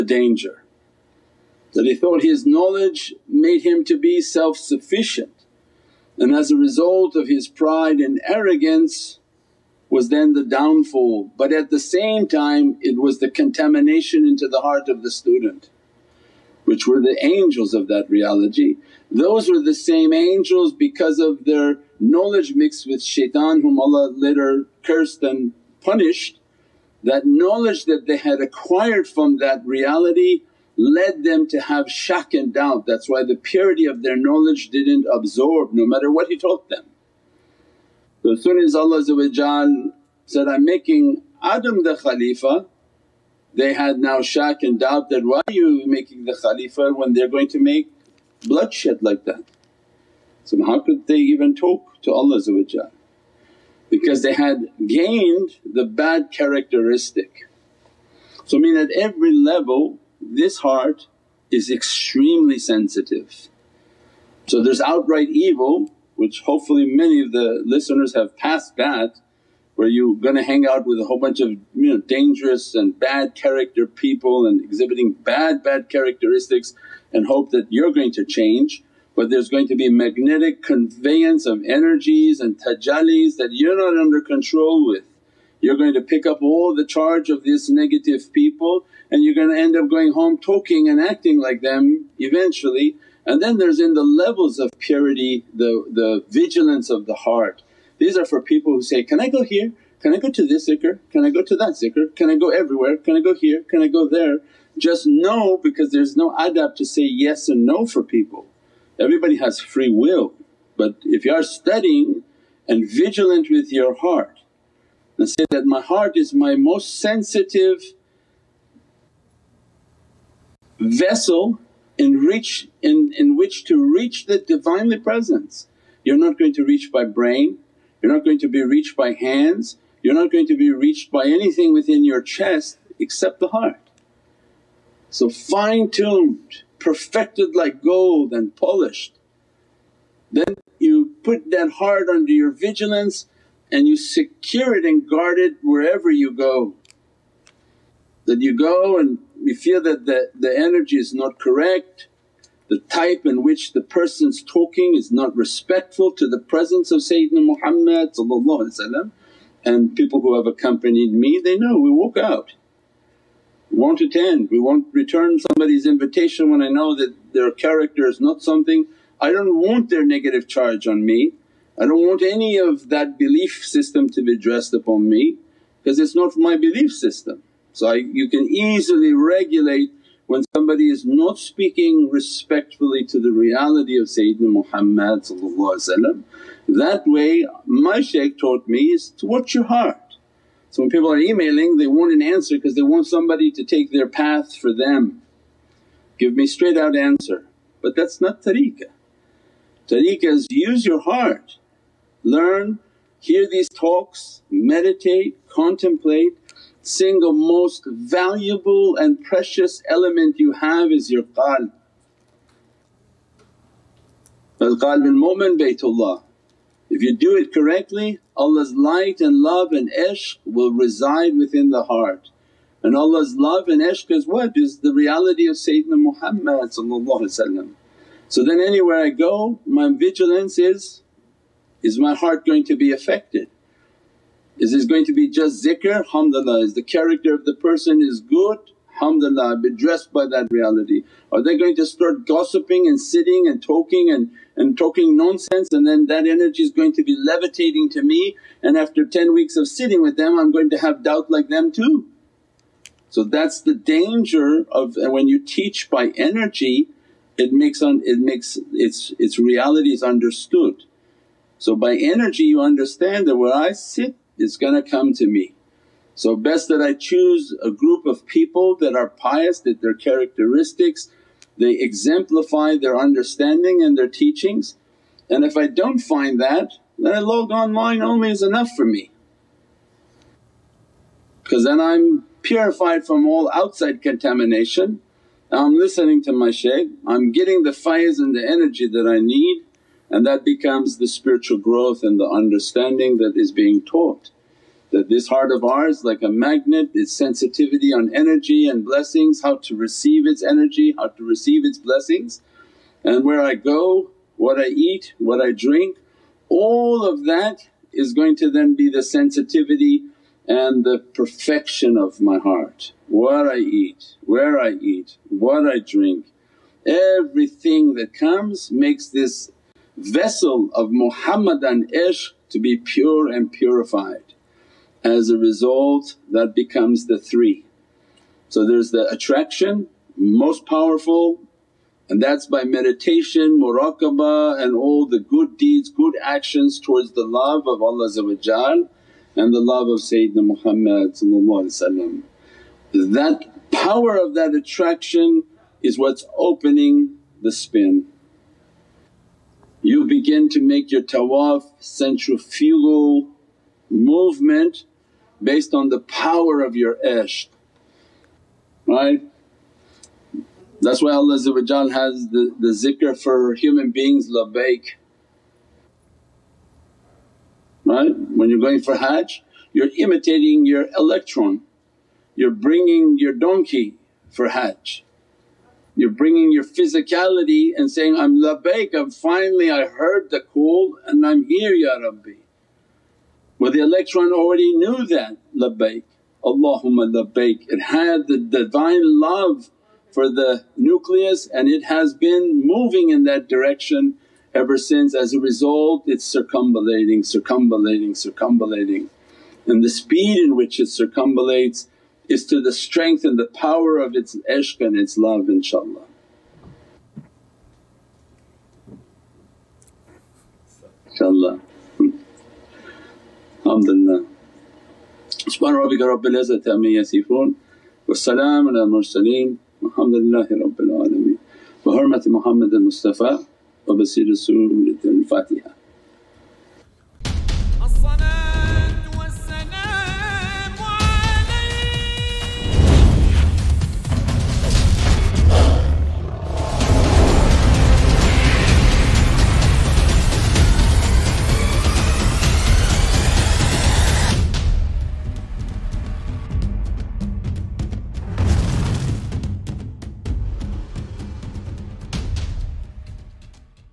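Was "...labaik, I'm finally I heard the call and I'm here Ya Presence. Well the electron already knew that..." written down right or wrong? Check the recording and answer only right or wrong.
wrong.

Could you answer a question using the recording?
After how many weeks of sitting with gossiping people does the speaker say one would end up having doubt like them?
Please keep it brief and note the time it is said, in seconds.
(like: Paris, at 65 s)
10, at 249 s.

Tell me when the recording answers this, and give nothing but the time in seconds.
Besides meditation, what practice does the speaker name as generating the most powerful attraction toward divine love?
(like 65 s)
333 s.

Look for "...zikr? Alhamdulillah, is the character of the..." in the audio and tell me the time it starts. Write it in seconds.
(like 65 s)
235 s.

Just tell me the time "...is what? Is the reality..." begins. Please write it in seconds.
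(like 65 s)
224 s.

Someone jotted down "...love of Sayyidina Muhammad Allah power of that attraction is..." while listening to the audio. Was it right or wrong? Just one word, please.
wrong.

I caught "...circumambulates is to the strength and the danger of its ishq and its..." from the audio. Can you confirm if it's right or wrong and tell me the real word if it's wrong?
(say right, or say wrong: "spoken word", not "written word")
wrong: "power", not "danger".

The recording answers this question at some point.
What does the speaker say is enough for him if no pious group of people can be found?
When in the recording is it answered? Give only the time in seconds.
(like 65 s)
277 s.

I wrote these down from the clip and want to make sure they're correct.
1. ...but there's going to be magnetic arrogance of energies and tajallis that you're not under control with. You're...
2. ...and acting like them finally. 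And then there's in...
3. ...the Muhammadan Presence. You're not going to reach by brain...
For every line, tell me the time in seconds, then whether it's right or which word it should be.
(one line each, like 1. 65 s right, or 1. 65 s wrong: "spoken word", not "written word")
1. 79 s wrong: "conveyance", not "arrogance"
2. 90 s wrong: "eventually", not "finally"
3. 124 s wrong: "Divinely", not "Muhammadan".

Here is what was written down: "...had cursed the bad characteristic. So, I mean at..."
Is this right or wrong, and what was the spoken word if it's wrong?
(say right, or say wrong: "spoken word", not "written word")
wrong: "gained", not "cursed".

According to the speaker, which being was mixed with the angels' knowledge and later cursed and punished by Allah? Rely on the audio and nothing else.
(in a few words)
Shaitan.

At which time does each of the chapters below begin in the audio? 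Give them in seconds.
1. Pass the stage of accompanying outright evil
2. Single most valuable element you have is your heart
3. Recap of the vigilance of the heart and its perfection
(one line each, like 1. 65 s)
1. 57 s
2. 205 s
3. 289 s.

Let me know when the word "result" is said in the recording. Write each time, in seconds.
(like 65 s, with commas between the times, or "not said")
6 s, 325 s, 395 s.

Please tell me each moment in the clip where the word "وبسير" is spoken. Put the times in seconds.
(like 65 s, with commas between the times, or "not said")
423 s.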